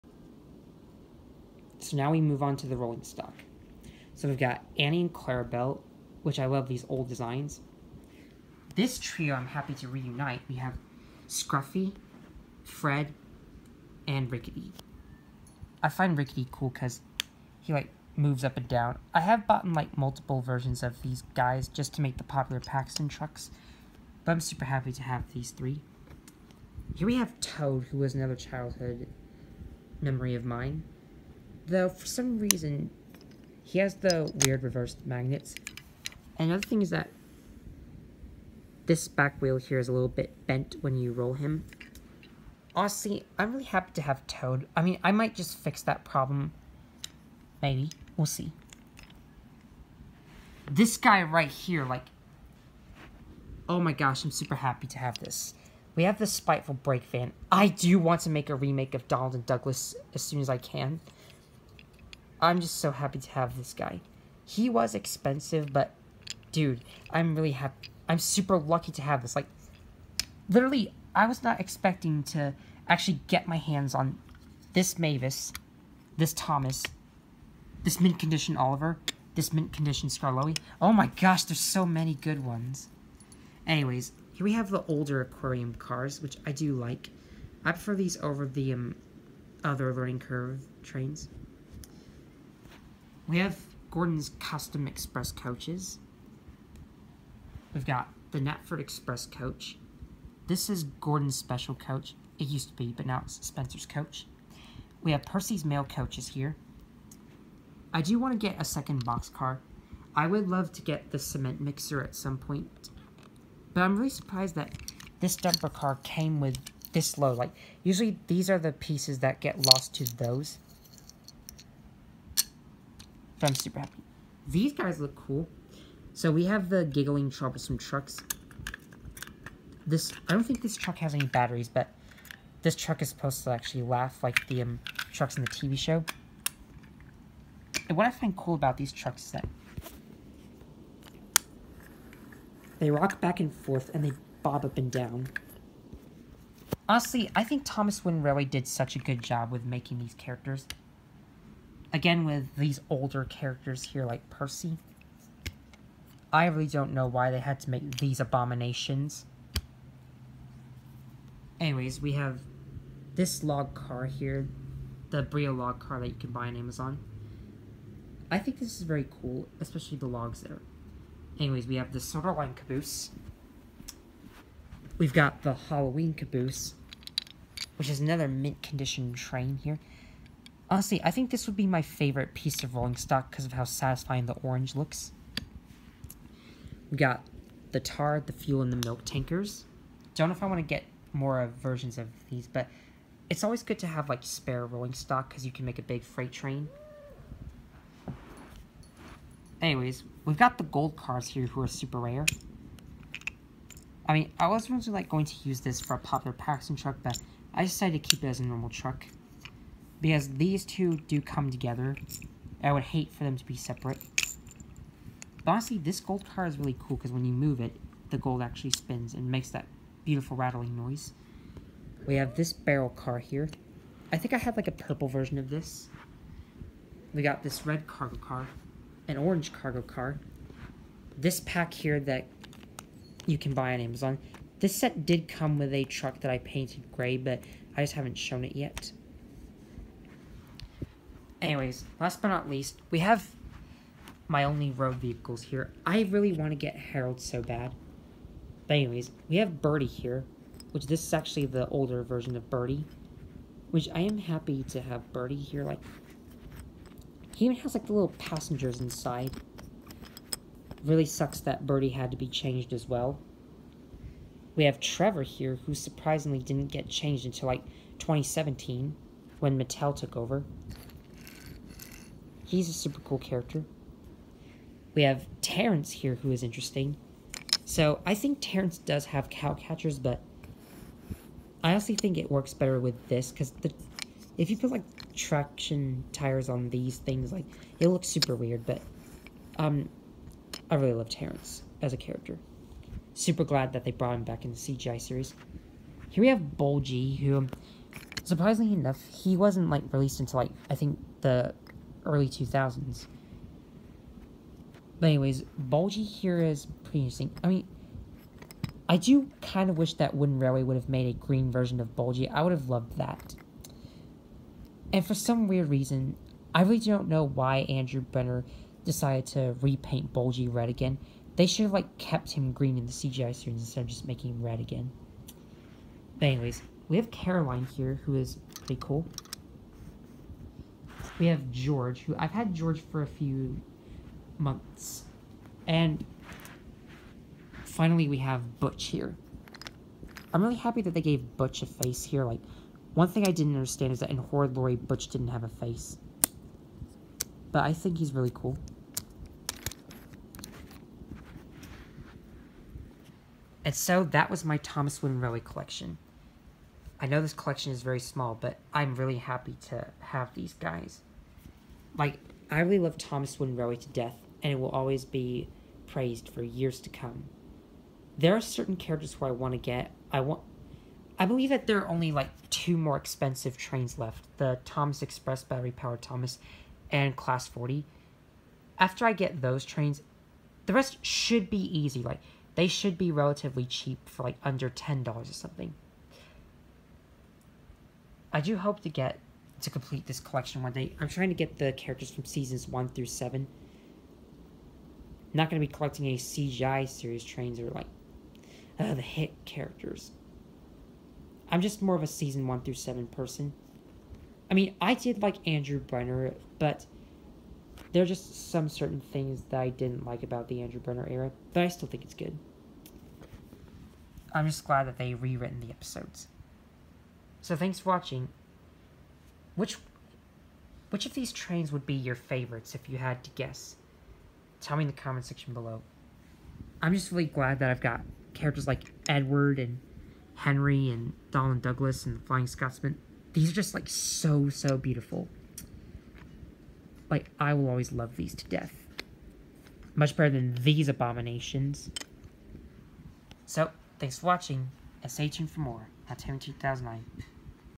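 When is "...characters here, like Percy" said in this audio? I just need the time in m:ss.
2:33.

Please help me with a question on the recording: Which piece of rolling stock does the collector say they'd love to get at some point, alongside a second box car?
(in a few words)
cement mixer.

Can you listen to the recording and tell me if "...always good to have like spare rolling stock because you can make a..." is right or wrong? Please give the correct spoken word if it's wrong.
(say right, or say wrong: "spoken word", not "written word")
right.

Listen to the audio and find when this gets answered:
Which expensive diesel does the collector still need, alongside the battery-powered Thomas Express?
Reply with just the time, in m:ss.
6:17.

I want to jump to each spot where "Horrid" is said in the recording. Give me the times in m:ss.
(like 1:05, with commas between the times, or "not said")
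5:44.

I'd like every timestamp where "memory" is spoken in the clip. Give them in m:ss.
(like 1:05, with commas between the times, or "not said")
0:30.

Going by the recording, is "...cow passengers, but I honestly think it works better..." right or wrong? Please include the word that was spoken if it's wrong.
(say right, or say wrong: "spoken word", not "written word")
wrong: "catchers", not "passengers".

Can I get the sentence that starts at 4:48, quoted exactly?
But um, I really love Terrence as a character.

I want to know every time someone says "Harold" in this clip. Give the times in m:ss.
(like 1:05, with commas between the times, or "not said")
4:06.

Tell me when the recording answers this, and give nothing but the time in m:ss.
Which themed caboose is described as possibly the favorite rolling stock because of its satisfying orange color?
2:55.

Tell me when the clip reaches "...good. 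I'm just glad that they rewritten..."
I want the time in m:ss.
6:52.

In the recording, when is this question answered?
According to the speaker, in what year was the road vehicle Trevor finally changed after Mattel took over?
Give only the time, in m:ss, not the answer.
4:27.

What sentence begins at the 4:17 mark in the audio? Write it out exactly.
He even has like the little passengers inside.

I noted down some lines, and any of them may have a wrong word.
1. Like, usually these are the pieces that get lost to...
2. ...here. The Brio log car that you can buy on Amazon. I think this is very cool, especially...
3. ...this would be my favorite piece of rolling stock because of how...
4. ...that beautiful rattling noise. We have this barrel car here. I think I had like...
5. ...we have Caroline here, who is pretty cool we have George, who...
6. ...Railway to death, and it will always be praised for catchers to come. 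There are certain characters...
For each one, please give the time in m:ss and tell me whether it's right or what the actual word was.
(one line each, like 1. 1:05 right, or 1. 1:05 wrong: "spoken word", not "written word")
1. 1:57 right
2. 2:44 right
3. 3:01 right
4. 3:39 right
5. 5:26 right
6. 6:03 wrong: "years", not "catchers".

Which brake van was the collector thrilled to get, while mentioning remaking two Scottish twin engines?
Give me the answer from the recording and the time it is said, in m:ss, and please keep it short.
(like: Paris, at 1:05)
Spiteful Brake Van, at 0:56.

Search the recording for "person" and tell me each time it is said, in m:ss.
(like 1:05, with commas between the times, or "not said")
6:43.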